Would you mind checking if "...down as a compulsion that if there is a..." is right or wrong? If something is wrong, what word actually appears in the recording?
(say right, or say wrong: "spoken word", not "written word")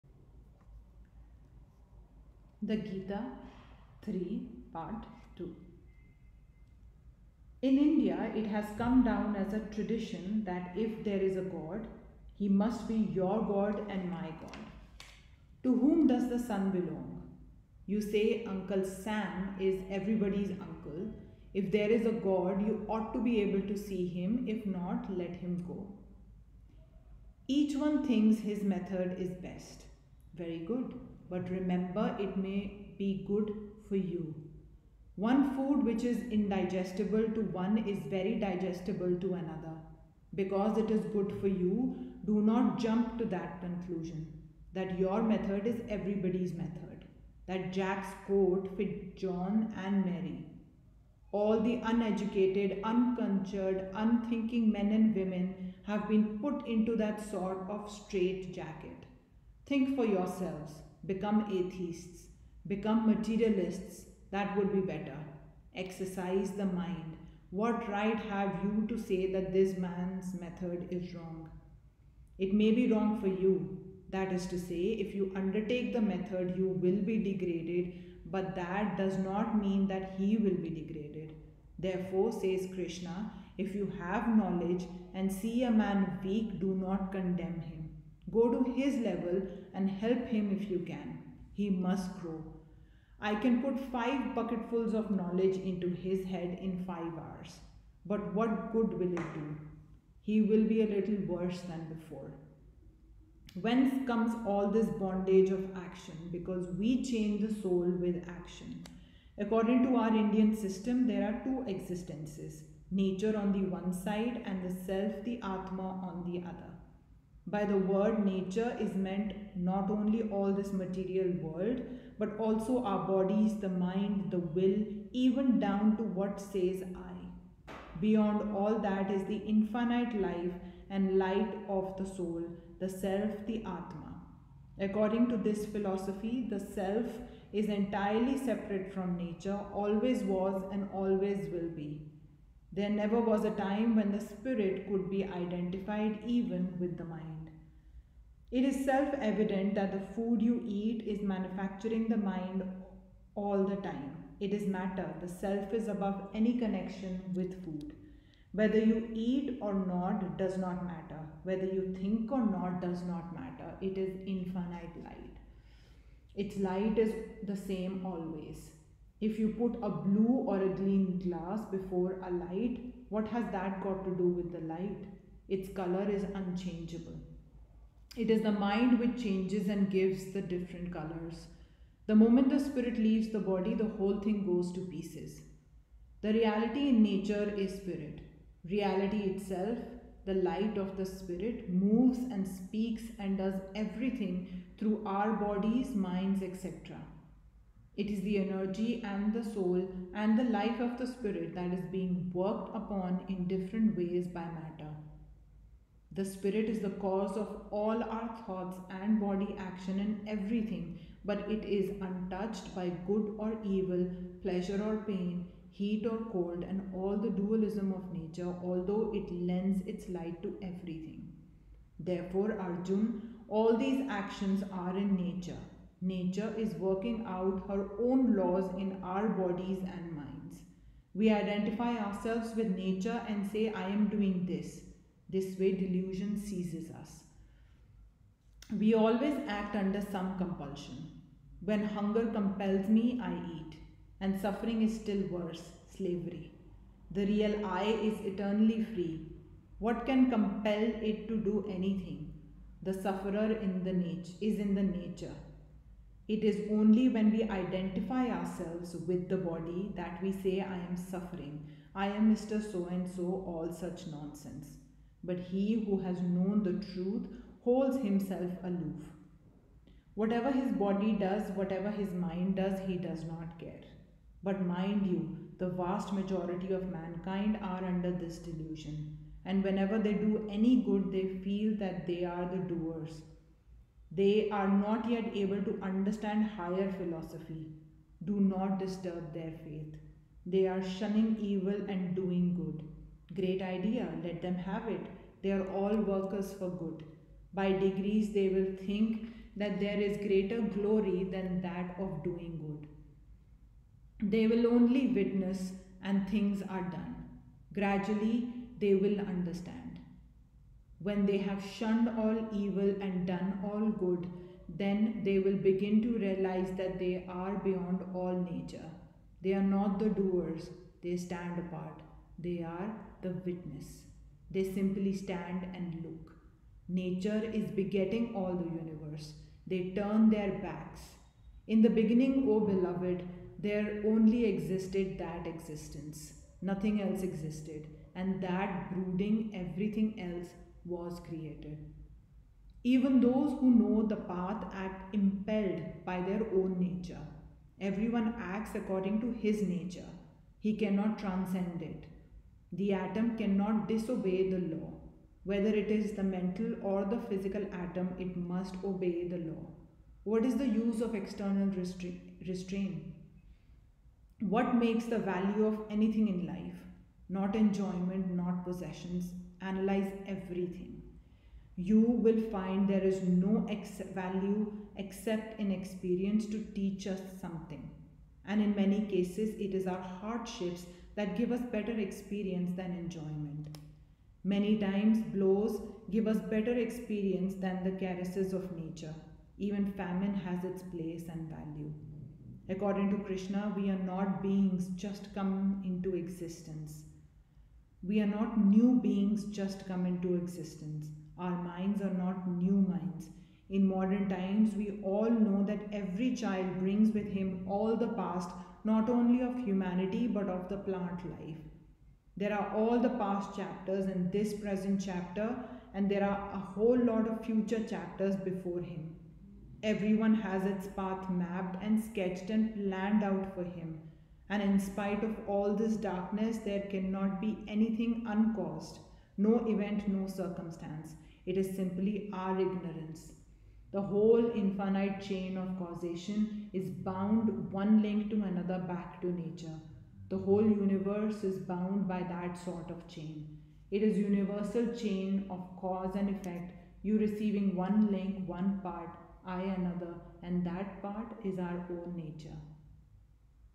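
wrong: "tradition", not "compulsion".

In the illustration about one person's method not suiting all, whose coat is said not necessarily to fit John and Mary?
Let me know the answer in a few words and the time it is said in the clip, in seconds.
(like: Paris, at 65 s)
Jack's, at 47 s.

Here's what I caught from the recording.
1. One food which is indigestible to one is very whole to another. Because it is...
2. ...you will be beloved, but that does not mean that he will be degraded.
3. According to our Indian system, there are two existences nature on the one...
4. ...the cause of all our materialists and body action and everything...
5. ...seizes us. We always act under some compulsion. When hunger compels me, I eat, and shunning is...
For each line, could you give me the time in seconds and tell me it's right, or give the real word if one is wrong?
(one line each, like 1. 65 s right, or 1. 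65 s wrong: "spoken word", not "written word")
1. 35 s wrong: "digestible", not "whole"
2. 76 s wrong: "degraded", not "beloved"
3. 109 s right
4. 206 s wrong: "thoughts", not "materialists"
5. 236 s wrong: "suffering", not "shunning".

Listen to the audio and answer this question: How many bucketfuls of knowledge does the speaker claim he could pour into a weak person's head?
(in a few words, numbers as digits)
5.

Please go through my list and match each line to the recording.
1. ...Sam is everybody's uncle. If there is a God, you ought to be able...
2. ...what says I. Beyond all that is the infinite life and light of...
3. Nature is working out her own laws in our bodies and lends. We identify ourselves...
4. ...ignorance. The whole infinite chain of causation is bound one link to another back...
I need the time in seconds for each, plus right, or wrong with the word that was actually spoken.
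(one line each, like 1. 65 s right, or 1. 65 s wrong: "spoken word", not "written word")
1. 18 s right
2. 126 s right
3. 226 s wrong: "minds", not "lends"
4. 432 s right.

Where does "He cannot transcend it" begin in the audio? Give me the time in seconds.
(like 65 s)
350 s.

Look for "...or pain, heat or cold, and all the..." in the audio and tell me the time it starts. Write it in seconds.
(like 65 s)
214 s.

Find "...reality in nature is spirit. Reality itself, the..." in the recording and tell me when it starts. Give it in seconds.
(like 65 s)
186 s.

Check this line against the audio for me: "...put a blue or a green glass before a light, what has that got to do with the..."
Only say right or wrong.
right.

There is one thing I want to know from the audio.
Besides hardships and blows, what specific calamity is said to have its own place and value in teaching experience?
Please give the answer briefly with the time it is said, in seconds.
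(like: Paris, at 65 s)
Famine, at 389 s.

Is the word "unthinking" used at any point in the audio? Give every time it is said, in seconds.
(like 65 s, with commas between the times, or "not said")
53 s.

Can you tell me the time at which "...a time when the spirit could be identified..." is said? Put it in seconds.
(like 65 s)
143 s.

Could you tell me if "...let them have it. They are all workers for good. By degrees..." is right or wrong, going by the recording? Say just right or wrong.
right.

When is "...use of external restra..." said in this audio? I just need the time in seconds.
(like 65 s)
360 s.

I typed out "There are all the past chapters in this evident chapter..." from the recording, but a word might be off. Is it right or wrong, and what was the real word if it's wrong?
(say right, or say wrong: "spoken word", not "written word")
wrong: "present", not "evident".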